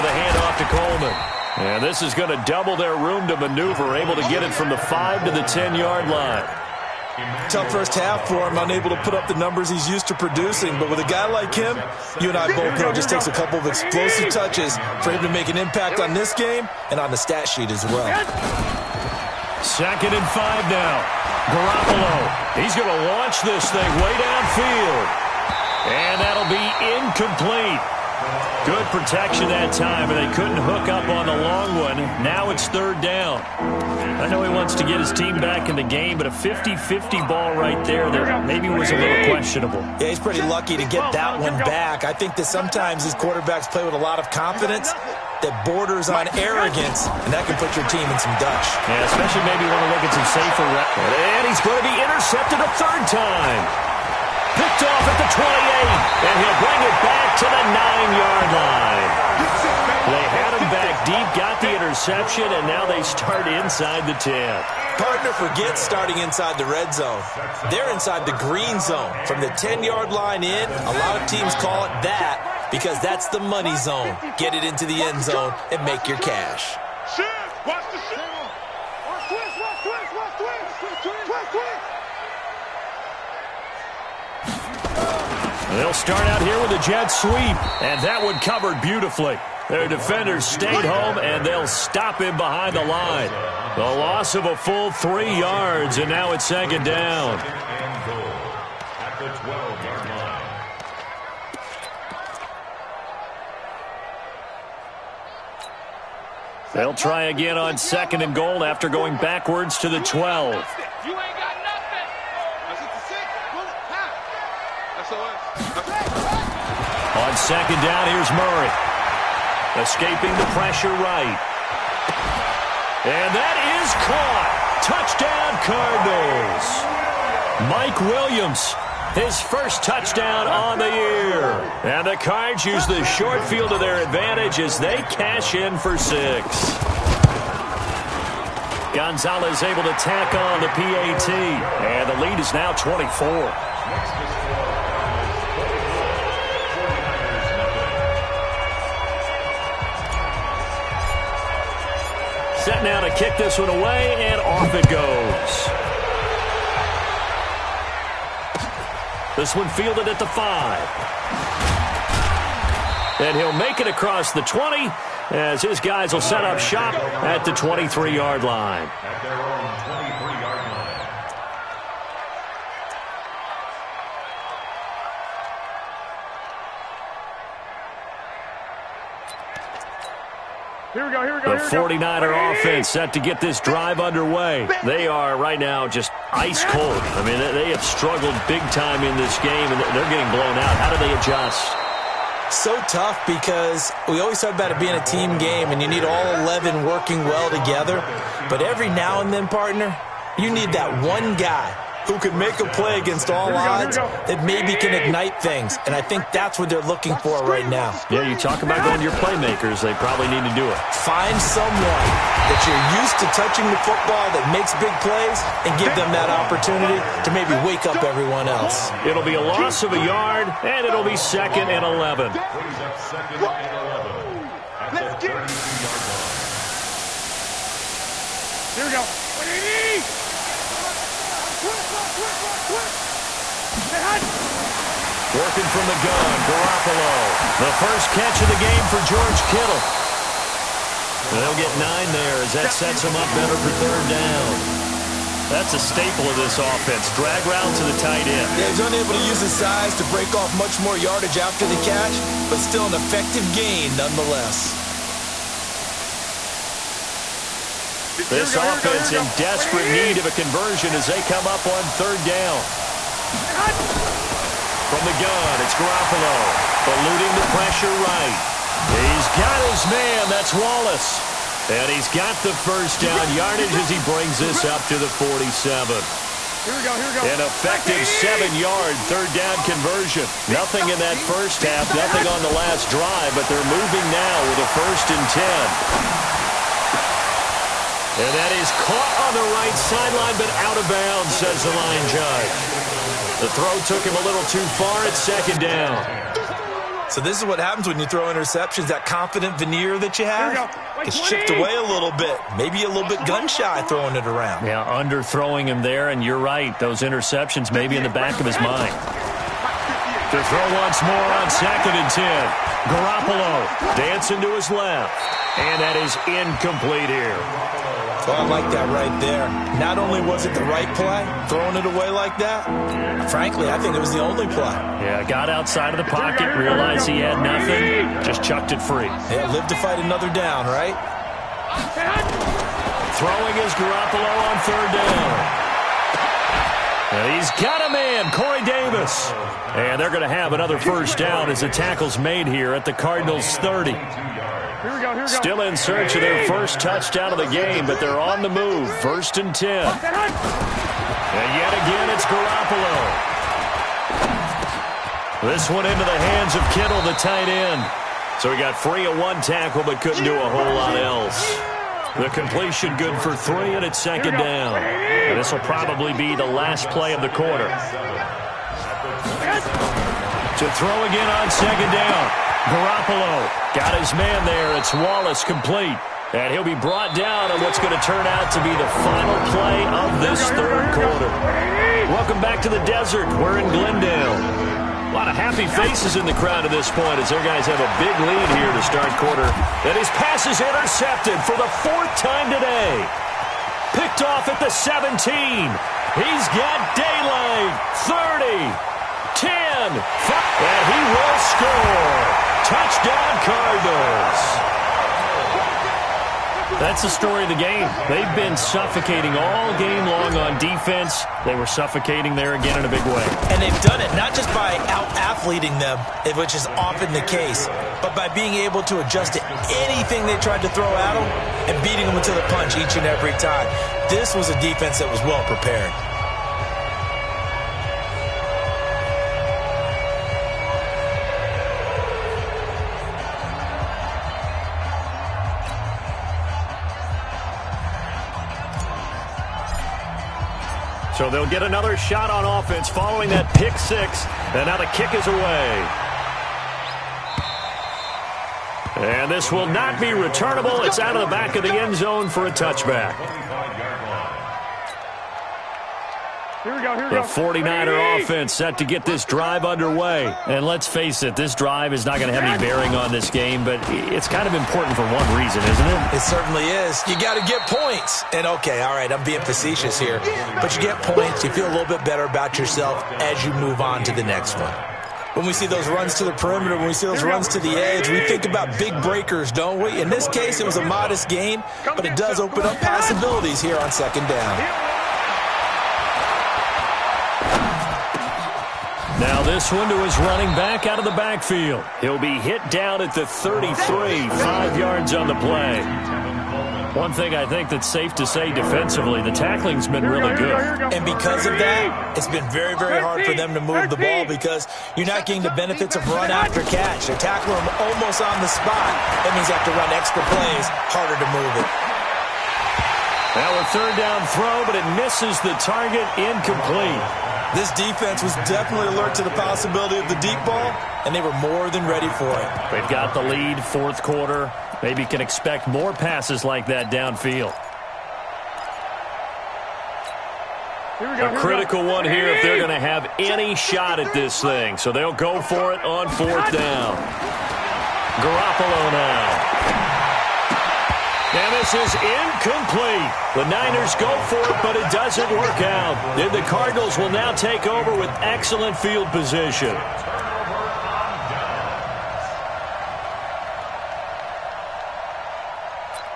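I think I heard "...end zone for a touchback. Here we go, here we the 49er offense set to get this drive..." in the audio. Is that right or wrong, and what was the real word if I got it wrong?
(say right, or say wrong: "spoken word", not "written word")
right.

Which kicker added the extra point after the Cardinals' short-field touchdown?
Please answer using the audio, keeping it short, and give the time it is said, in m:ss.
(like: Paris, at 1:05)
Gonzalez, at 2:18.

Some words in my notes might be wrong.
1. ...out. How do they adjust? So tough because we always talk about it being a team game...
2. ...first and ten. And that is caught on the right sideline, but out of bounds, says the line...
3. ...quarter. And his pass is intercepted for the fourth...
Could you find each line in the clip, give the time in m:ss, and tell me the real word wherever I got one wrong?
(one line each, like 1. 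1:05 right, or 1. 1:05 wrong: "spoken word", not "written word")
1. 3:10 right
2. 4:44 right
3. 6:29 right.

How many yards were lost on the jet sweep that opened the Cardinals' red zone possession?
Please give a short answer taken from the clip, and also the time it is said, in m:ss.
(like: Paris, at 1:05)
3, at 1:34.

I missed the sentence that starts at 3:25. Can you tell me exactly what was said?
And I think that's what they're looking for right now.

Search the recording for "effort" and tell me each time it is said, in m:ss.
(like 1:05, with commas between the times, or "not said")
not said.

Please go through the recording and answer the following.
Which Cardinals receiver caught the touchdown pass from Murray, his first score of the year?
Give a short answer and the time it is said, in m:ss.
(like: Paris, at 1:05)
Mike Williams, at 2:07.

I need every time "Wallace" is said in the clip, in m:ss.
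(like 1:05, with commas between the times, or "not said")
4:30, 6:14.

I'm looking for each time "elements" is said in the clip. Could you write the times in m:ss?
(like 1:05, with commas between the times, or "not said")
not said.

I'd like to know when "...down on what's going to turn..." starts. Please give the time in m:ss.
6:17.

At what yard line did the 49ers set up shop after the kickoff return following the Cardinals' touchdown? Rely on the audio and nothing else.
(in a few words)
23-yard line.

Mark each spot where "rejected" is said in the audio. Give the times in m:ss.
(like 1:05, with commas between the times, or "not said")
not said.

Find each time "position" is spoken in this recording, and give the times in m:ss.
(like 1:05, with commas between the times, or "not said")
9:09.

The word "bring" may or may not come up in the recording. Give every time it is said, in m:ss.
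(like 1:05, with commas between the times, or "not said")
0:56, 4:33.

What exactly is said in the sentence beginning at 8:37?
This defense was definitely alert to the possibility of the deep ball, and they were more than ready for it.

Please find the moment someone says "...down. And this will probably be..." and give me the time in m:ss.
6:04.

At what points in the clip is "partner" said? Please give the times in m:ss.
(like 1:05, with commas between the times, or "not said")
1:04, 3:19.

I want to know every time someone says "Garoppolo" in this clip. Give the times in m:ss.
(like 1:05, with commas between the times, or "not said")
0:21, 3:56, 4:25, 5:12, 5:33, 5:52, 6:12, 8:58.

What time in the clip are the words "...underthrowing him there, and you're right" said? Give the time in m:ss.
5:04.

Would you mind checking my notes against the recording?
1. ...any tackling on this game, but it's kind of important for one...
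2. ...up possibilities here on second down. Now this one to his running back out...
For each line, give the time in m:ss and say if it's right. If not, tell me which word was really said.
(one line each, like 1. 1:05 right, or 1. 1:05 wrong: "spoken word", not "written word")
1. 7:42 wrong: "bearing", not "tackling"
2. 8:02 right.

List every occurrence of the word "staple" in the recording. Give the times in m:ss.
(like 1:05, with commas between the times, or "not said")
4:05.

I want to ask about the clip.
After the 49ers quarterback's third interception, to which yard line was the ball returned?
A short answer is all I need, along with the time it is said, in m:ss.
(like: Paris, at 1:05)
9-yard line, at 0:57.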